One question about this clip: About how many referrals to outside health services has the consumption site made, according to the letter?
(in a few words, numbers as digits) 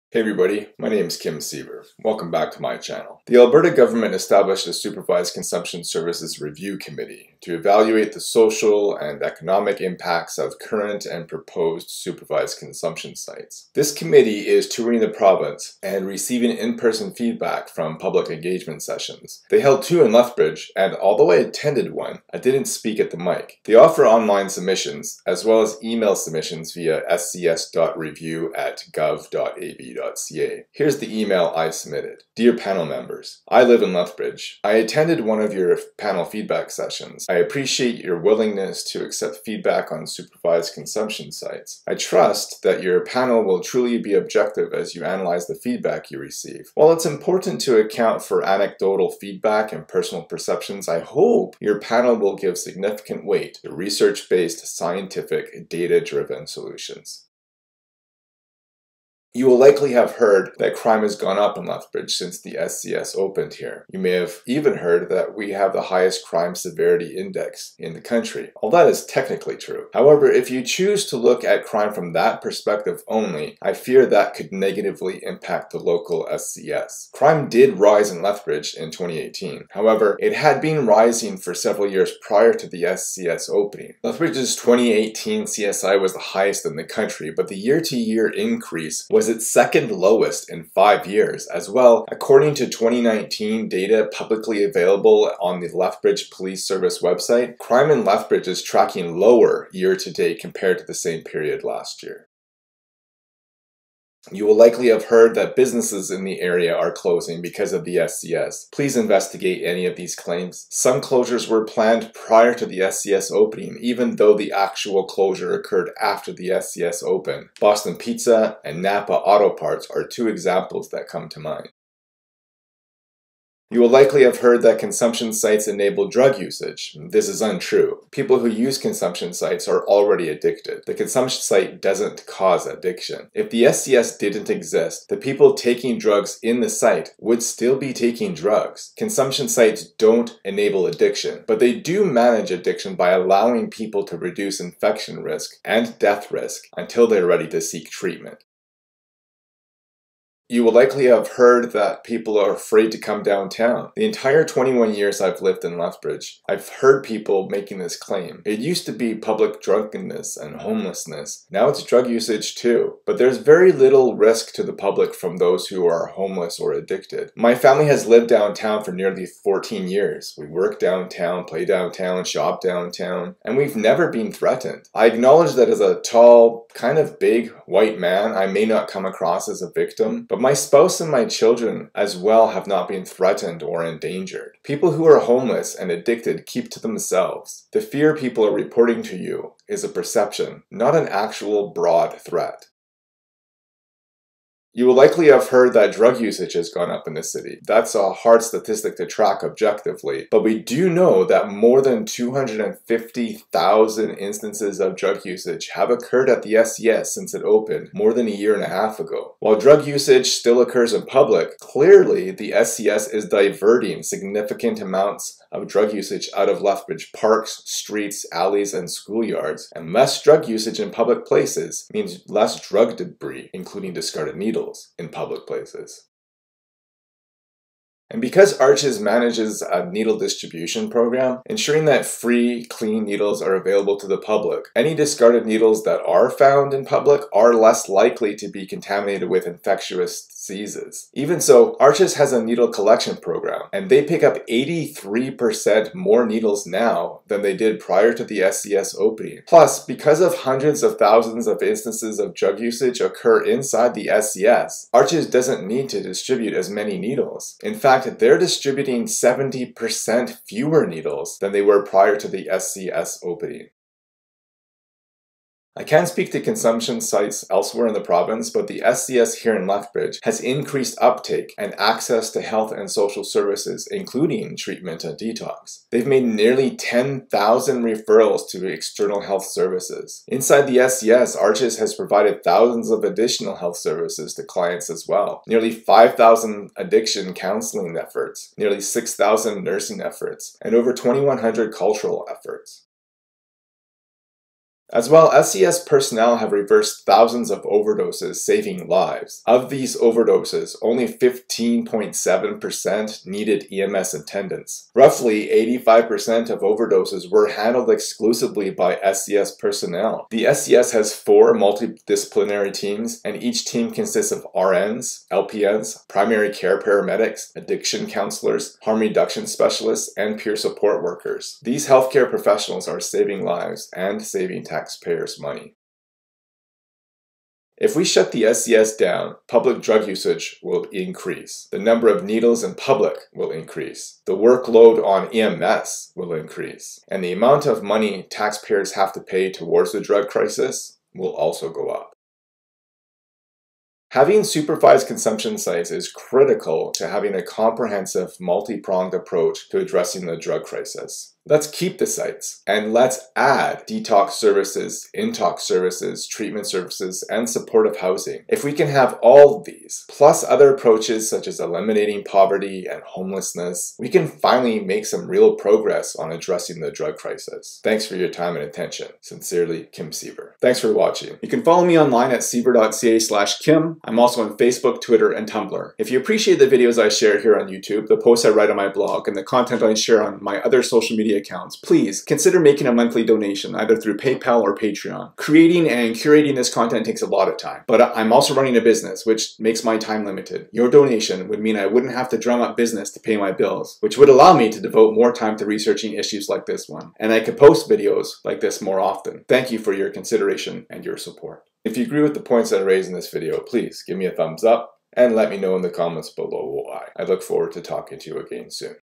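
10,000.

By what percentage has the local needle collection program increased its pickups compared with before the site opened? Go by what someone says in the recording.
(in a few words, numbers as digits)
83%.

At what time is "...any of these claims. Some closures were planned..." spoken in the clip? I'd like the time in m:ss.
1:49.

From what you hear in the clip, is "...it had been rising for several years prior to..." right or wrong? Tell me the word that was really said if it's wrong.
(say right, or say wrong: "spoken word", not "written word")
right.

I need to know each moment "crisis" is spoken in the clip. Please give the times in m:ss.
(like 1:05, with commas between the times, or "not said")
5:40, 5:50, 6:07.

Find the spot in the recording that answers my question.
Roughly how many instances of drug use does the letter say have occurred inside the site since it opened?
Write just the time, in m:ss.
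3:22.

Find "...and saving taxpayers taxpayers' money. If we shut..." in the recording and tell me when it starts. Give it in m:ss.
5:23.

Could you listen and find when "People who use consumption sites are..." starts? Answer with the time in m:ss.
2:08.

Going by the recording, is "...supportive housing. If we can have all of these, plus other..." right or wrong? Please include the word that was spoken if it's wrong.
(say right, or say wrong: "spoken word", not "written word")
right.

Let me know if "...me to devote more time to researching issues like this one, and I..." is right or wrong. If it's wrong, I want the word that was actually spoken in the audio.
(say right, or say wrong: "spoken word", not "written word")
right.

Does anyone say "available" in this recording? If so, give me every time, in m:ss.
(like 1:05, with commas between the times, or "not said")
1:34, 3:53.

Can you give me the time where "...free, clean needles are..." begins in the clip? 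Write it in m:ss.
3:52.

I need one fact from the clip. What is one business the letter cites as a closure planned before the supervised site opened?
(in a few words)
Boston Pizza.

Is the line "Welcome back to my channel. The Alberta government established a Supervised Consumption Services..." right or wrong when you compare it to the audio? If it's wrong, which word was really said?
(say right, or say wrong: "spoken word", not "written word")
right.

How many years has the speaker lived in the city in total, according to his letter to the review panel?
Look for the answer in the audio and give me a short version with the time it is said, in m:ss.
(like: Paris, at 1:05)
21, at 2:34.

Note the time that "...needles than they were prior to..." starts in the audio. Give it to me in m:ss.
4:20.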